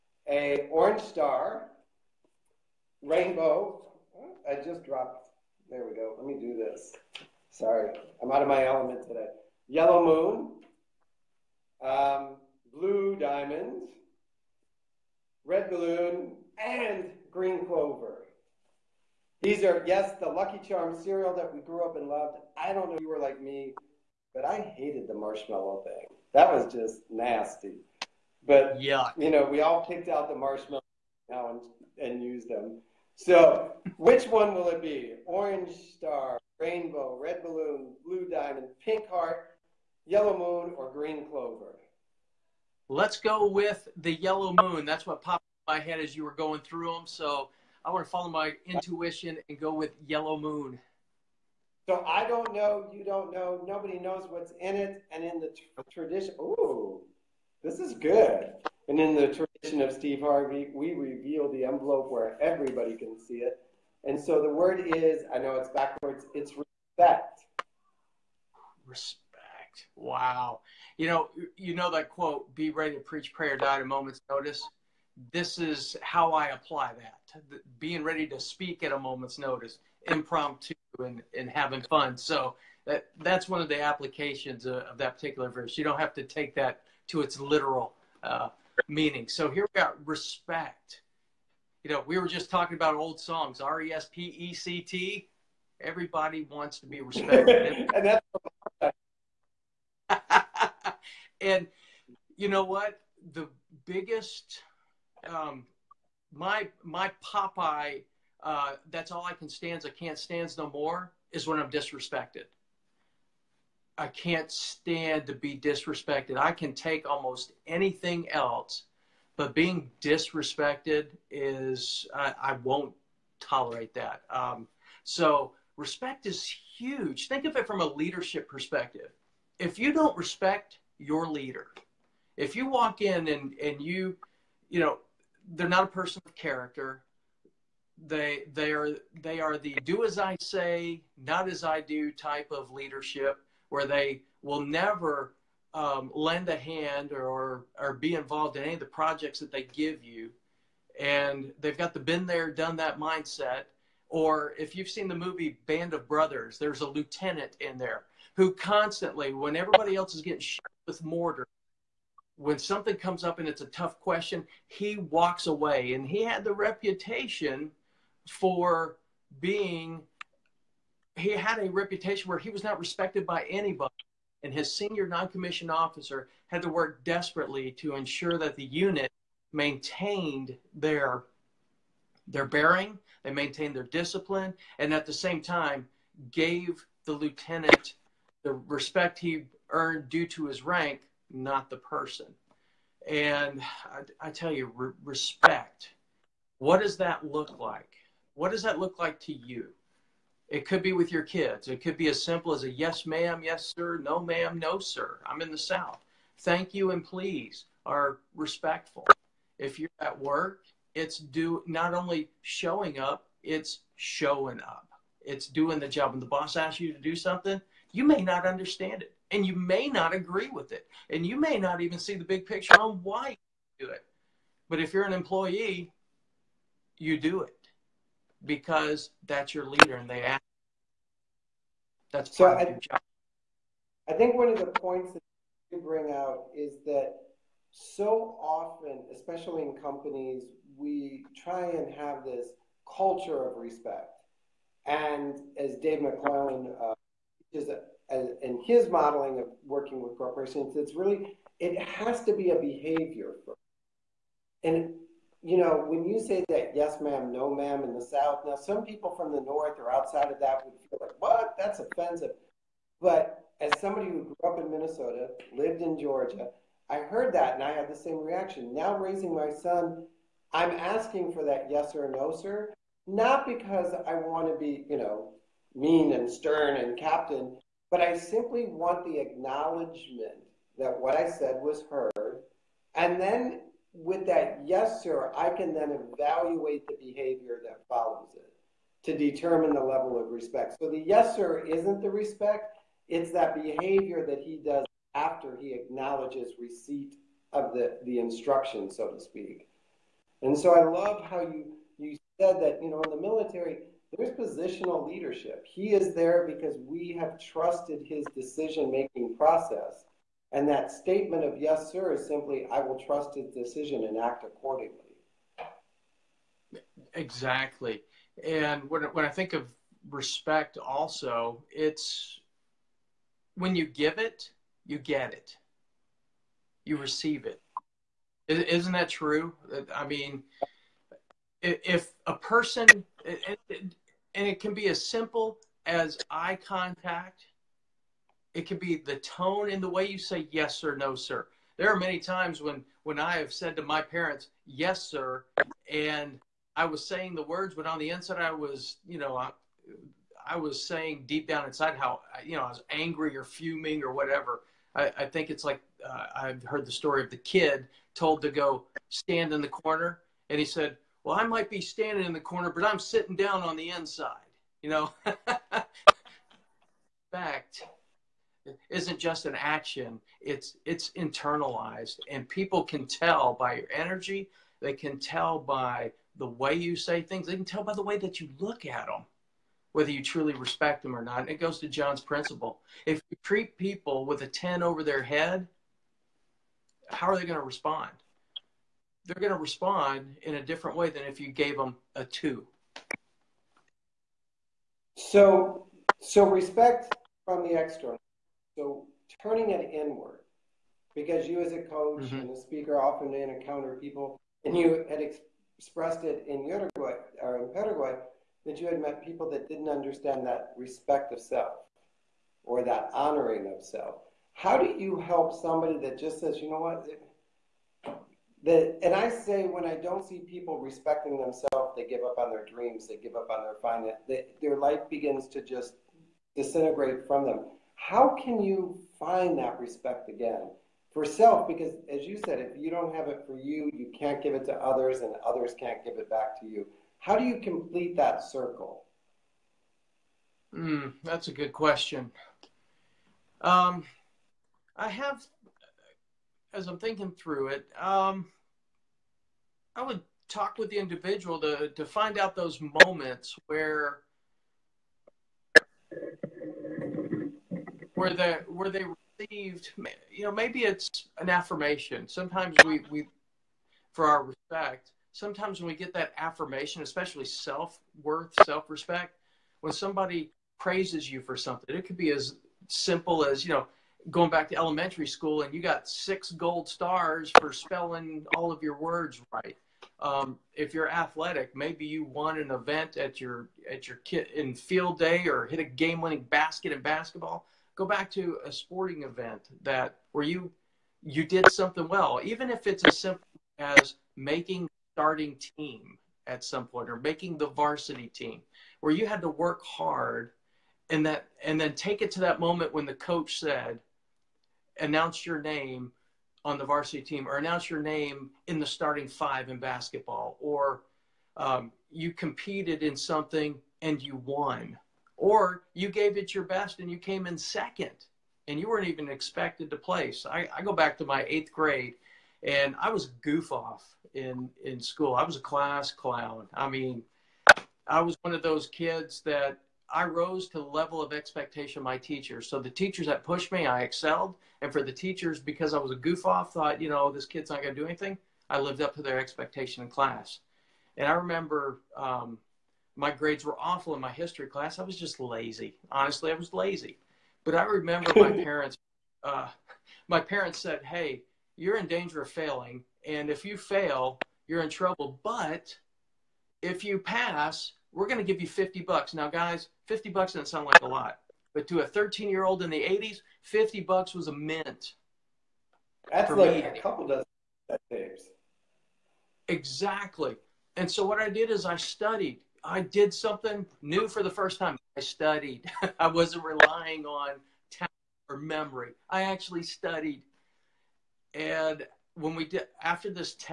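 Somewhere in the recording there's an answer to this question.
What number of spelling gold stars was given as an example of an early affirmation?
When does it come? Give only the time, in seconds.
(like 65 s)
476 s.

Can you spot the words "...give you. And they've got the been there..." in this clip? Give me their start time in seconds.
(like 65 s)
149 s.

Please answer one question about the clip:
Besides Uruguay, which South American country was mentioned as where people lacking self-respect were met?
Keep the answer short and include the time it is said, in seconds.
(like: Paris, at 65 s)
Paraguay, at 407 s.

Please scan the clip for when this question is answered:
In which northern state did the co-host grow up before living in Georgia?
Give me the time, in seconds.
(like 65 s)
264 s.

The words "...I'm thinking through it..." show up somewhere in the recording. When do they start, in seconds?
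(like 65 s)
446 s.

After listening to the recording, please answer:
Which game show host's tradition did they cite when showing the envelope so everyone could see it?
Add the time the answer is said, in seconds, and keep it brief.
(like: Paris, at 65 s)
Steve Harvey, at 59 s.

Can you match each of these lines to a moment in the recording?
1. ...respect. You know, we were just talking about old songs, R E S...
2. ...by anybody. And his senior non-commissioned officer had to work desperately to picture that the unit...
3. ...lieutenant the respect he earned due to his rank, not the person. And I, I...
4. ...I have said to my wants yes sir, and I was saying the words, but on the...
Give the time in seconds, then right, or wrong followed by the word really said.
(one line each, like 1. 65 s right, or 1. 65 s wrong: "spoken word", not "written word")
1. 90 s right
2. 173 s wrong: "ensure", not "picture"
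3. 187 s right
4. 343 s wrong: "parents", not "wants".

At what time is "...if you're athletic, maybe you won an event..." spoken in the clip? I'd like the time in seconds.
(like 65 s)
480 s.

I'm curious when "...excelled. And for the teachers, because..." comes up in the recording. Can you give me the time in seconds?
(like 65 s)
534 s.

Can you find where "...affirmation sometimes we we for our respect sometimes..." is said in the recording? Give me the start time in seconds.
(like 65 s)
461 s.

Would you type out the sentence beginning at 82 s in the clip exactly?
So that that's one of the applications of, of that particular verse.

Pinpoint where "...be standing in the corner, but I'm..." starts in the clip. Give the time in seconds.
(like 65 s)
361 s.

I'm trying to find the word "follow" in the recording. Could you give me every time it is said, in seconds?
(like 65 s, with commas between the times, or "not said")
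48 s, 287 s.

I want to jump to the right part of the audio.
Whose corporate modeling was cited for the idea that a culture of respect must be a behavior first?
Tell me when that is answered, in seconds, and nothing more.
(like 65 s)
245 s.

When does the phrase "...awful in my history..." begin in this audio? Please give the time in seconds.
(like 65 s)
543 s.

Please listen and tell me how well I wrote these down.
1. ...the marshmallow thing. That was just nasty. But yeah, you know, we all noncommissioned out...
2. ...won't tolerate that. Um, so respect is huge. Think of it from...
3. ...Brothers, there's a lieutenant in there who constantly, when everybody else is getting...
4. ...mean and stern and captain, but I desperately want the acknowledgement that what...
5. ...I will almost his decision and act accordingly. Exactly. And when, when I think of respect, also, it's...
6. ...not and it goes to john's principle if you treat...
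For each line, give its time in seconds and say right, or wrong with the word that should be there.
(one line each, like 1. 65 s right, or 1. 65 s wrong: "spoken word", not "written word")
1. 25 s wrong: "picked", not "noncommissioned"
2. 122 s right
3. 156 s right
4. 275 s wrong: "simply", not "desperately"
5. 312 s wrong: "trust", not "almost"
6. 381 s right.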